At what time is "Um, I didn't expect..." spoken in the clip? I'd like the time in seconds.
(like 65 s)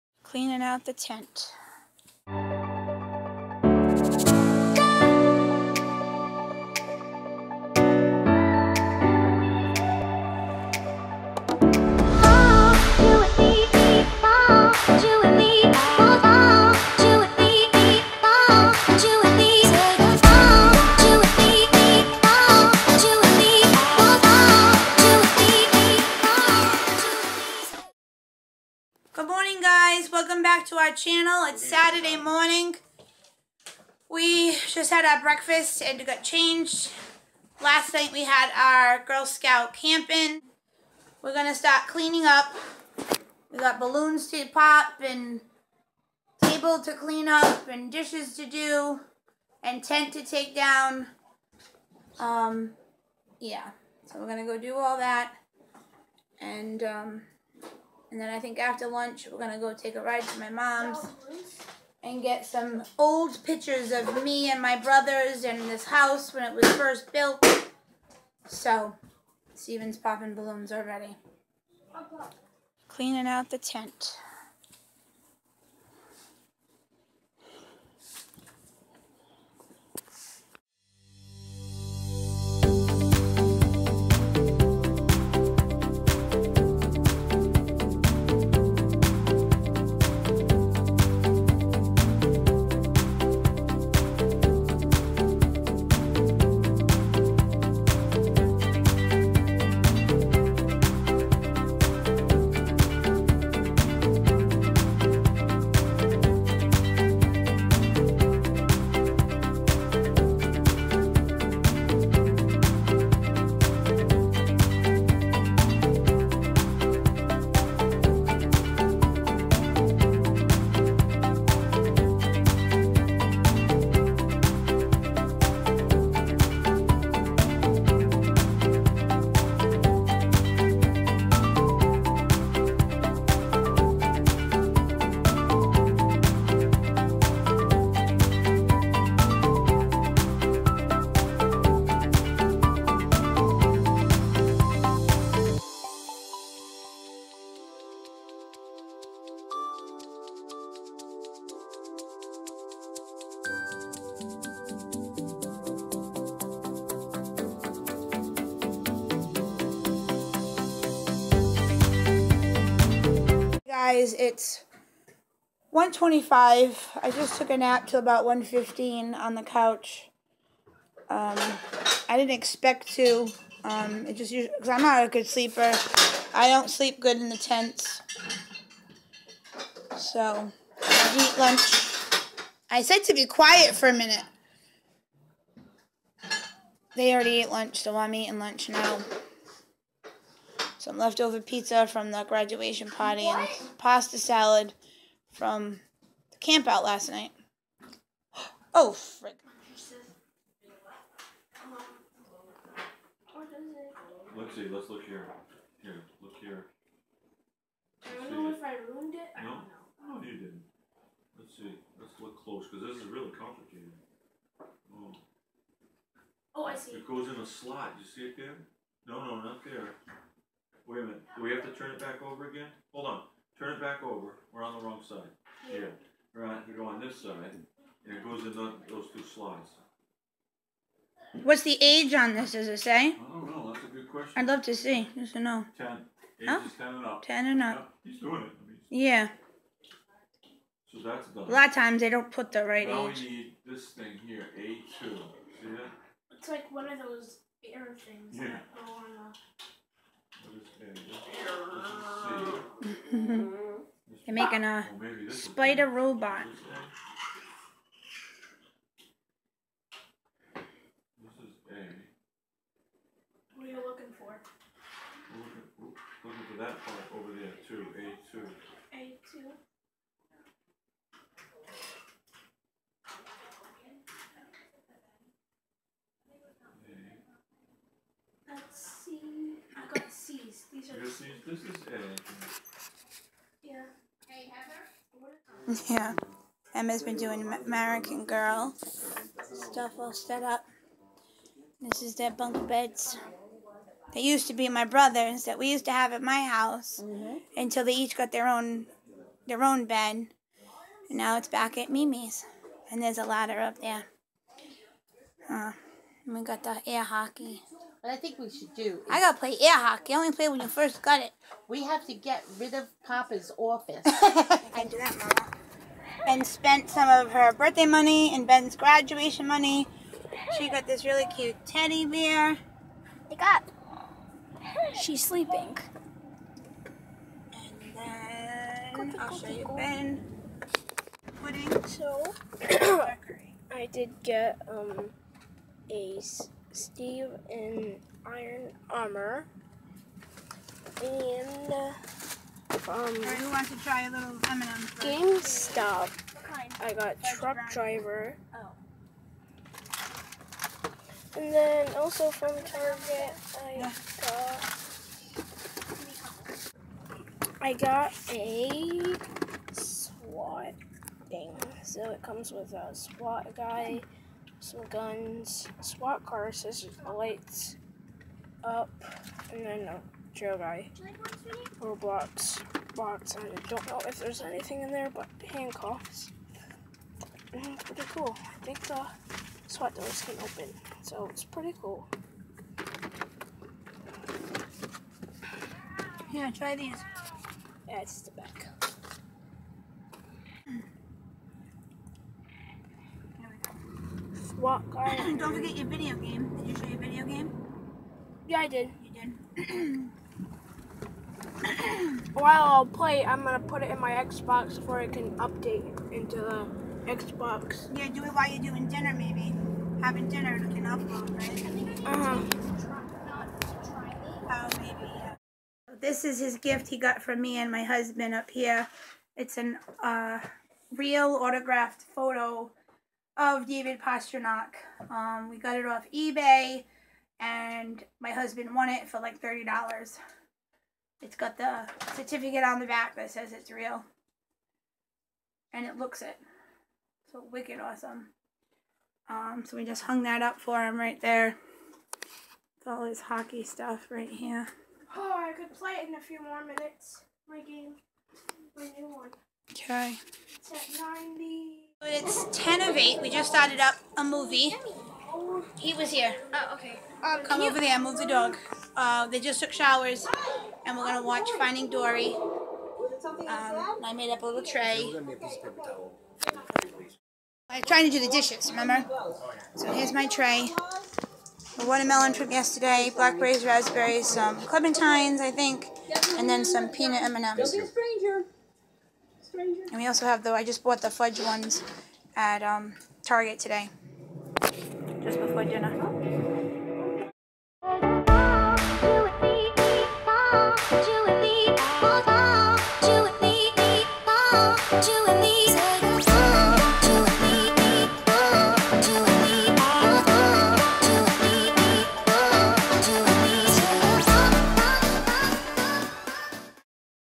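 171 s.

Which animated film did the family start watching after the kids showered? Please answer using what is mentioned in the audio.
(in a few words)
Finding Dory.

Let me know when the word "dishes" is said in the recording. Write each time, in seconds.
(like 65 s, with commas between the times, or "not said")
47 s, 468 s.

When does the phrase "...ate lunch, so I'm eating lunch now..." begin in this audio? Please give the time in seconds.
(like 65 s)
187 s.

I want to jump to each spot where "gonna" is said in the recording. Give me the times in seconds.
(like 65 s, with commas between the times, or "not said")
403 s, 461 s.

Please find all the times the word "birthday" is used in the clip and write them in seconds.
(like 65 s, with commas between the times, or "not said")
317 s.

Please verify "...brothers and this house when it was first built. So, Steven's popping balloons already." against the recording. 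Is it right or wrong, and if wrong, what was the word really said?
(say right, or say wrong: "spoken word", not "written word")
right.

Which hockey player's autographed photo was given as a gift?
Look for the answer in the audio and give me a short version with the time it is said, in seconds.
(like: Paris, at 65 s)
David Pastrnak, at 423 s.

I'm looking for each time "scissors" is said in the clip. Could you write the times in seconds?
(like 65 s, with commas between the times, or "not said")
366 s.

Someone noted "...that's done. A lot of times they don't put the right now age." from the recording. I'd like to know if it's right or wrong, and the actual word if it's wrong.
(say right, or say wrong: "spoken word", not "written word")
right.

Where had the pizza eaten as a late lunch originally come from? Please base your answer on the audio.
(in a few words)
graduation party.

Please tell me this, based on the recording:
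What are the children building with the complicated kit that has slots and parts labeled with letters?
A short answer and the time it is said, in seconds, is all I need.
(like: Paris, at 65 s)
a spider robot, at 255 s.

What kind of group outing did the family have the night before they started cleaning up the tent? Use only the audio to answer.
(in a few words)
Girl Scout camping.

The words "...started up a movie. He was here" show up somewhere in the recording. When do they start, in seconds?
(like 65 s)
453 s.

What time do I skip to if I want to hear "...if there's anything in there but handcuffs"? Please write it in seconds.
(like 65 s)
374 s.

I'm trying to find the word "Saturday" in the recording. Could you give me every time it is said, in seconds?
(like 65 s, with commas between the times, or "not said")
31 s.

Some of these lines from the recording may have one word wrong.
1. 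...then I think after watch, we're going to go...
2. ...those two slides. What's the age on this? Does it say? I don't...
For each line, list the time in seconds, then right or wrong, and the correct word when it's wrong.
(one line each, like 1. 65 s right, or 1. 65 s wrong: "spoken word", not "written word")
1. 58 s wrong: "lunch", not "watch"
2. 228 s right.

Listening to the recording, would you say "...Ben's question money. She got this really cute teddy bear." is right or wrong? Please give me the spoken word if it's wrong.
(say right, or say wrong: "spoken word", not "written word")
wrong: "graduation", not "question".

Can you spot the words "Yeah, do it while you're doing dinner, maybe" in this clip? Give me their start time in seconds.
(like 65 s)
407 s.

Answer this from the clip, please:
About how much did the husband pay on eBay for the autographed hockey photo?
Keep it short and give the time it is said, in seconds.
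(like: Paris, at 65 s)
$30, at 429 s.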